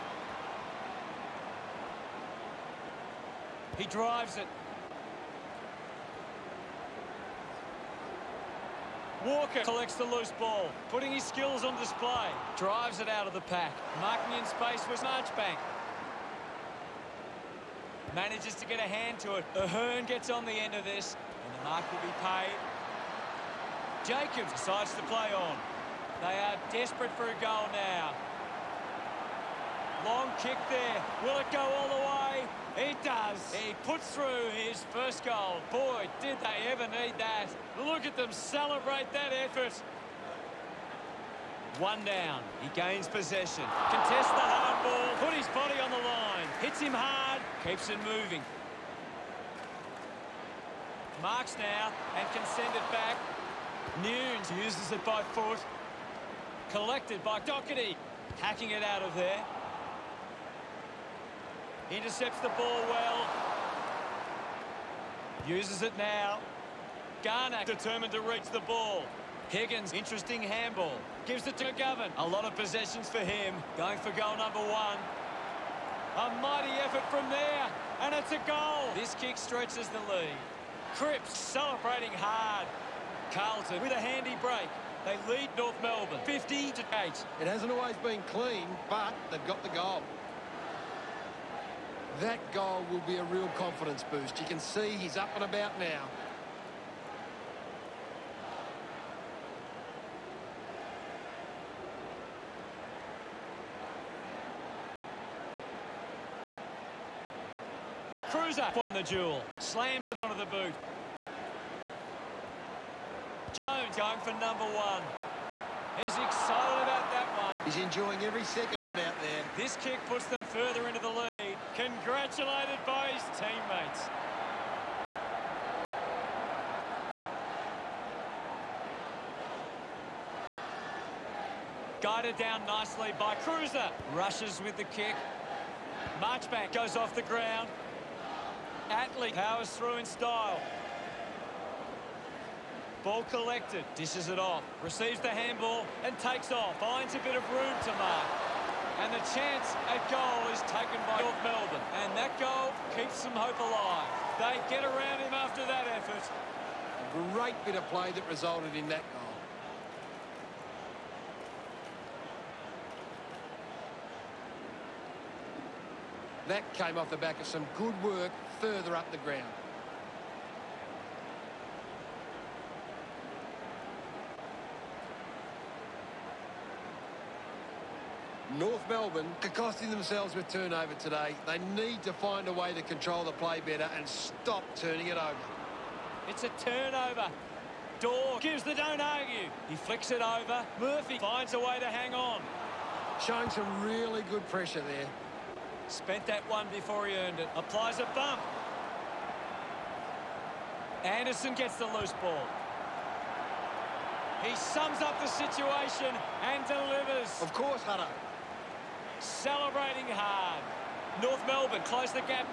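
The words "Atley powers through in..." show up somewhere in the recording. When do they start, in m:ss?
2:18.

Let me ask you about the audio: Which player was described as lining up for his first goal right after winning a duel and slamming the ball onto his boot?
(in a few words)
Jones.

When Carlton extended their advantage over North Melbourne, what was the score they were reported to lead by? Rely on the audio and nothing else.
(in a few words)
50 to 8.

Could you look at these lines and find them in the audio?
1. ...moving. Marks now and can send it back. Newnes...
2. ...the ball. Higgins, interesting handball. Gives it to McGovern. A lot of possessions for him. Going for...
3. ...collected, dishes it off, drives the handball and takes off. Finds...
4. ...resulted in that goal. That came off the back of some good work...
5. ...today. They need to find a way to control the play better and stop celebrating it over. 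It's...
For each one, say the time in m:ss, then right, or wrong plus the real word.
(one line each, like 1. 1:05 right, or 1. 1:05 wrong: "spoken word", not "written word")
1. 0:48 right
2. 1:08 right
3. 2:23 wrong: "receives", not "drives"
4. 2:38 right
5. 3:00 wrong: "turning", not "celebrating".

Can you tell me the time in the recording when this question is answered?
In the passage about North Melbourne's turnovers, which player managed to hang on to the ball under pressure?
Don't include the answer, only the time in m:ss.
3:10.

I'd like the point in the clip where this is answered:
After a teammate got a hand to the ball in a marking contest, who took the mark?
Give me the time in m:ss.
0:19.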